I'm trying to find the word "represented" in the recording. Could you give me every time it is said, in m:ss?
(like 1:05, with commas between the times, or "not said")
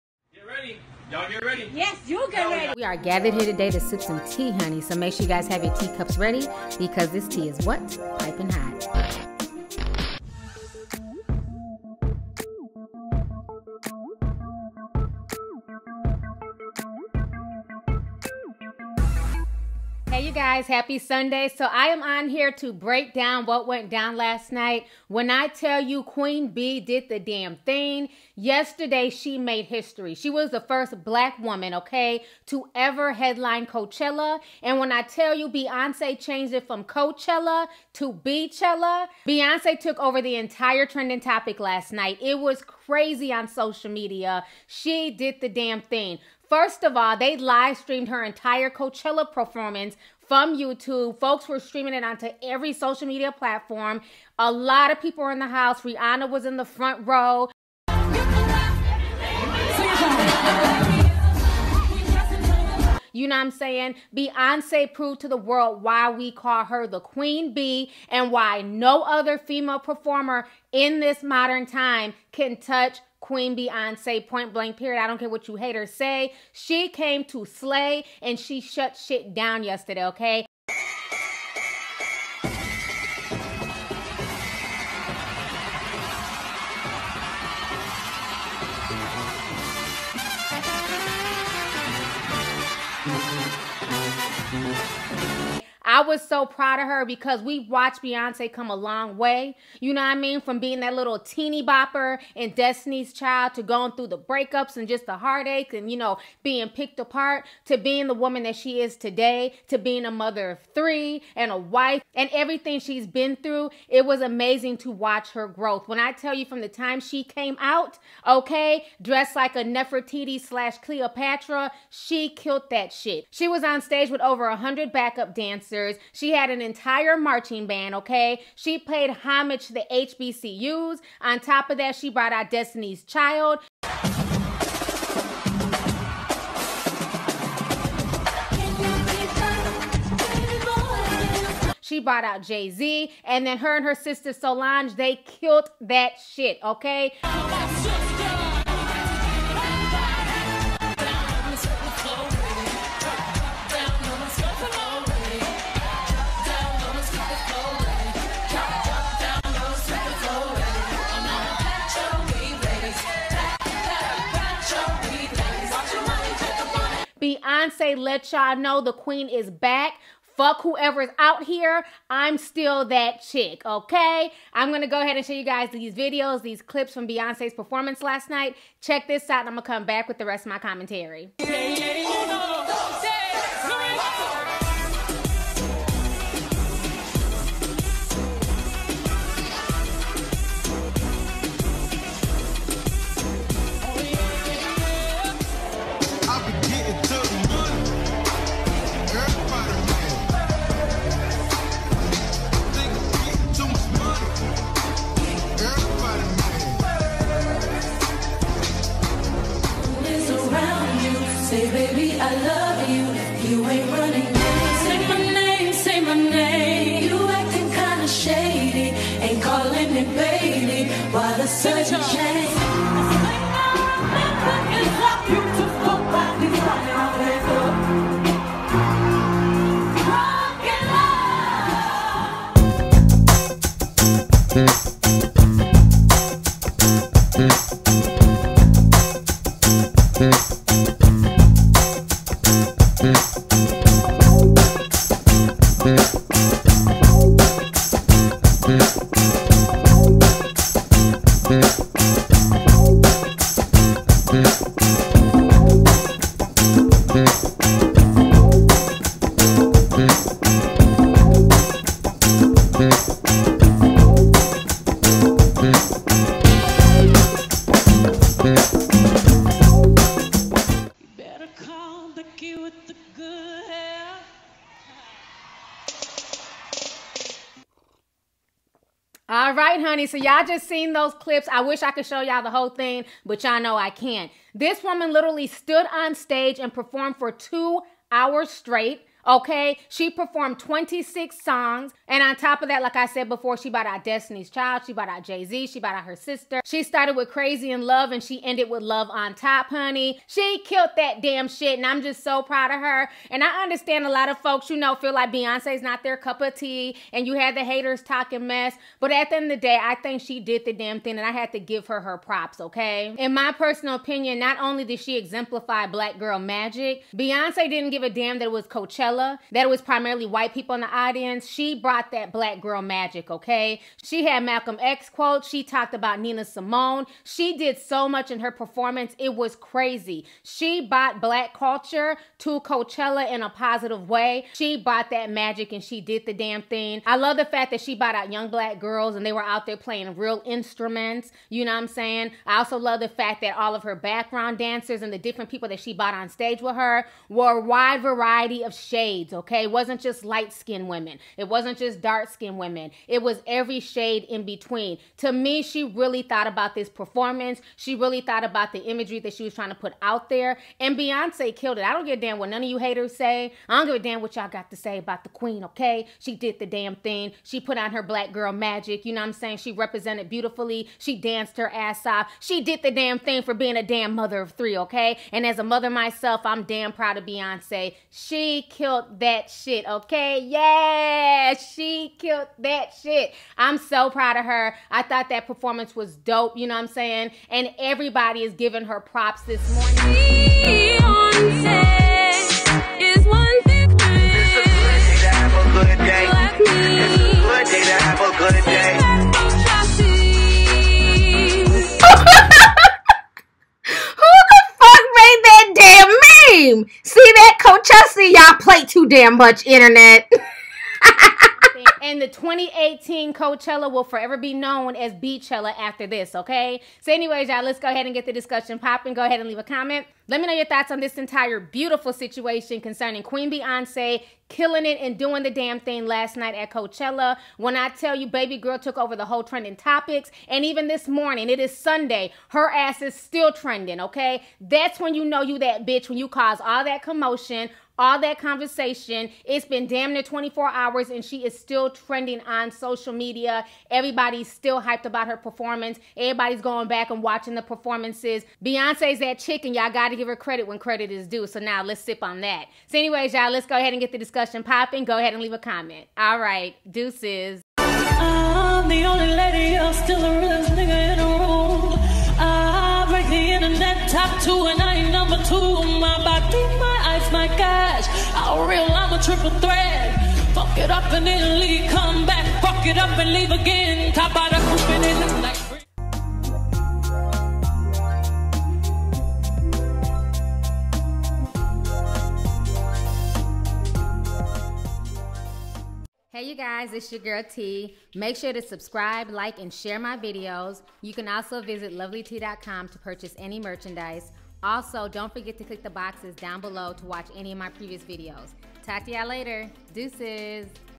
6:09.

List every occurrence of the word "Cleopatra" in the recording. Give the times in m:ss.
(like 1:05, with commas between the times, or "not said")
2:00.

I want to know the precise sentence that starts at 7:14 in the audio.
That's when you know you that bitch, when you cause all that commotion, all that conversation.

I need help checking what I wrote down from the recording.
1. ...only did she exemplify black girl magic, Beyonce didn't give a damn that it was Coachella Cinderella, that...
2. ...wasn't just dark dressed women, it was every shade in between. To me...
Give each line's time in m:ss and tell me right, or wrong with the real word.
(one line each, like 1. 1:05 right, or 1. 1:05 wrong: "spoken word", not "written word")
1. 5:14 right
2. 5:51 wrong: "skinned", not "dressed".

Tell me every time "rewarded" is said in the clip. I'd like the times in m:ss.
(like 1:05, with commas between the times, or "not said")
not said.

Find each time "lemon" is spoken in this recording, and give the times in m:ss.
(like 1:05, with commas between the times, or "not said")
not said.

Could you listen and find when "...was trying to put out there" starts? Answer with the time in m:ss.
5:59.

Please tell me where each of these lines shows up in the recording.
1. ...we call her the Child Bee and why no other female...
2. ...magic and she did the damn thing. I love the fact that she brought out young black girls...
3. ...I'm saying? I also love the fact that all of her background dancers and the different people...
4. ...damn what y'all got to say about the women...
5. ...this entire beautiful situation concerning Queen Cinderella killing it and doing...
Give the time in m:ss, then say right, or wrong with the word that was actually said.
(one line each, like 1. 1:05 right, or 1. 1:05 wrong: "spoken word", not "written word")
1. 1:06 wrong: "Queen", not "Child"
2. 5:35 right
3. 5:41 right
4. 6:03 wrong: "queen", not "women"
5. 7:00 wrong: "Beyonce", not "Cinderella".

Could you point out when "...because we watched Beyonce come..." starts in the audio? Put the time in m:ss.
1:37.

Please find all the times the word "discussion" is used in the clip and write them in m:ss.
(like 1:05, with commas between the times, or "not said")
6:58, 7:34.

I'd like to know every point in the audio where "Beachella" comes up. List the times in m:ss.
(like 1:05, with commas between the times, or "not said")
0:38, 6:55.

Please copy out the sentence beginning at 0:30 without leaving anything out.
She was the first black woman, okay, to ever headline Coachella.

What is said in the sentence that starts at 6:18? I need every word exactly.
She killed killed that shit, okay?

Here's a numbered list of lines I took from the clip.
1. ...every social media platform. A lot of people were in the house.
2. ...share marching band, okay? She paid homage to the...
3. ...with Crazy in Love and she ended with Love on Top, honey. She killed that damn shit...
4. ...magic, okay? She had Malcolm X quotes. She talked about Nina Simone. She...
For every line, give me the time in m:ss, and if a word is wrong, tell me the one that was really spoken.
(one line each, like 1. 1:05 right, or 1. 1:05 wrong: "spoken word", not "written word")
1. 0:52 right
2. 2:06 wrong: "entire", not "share"
3. 4:57 right
4. 5:22 right.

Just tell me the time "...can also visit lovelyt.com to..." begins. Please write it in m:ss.
8:11.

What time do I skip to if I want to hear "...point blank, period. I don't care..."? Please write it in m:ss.
1:14.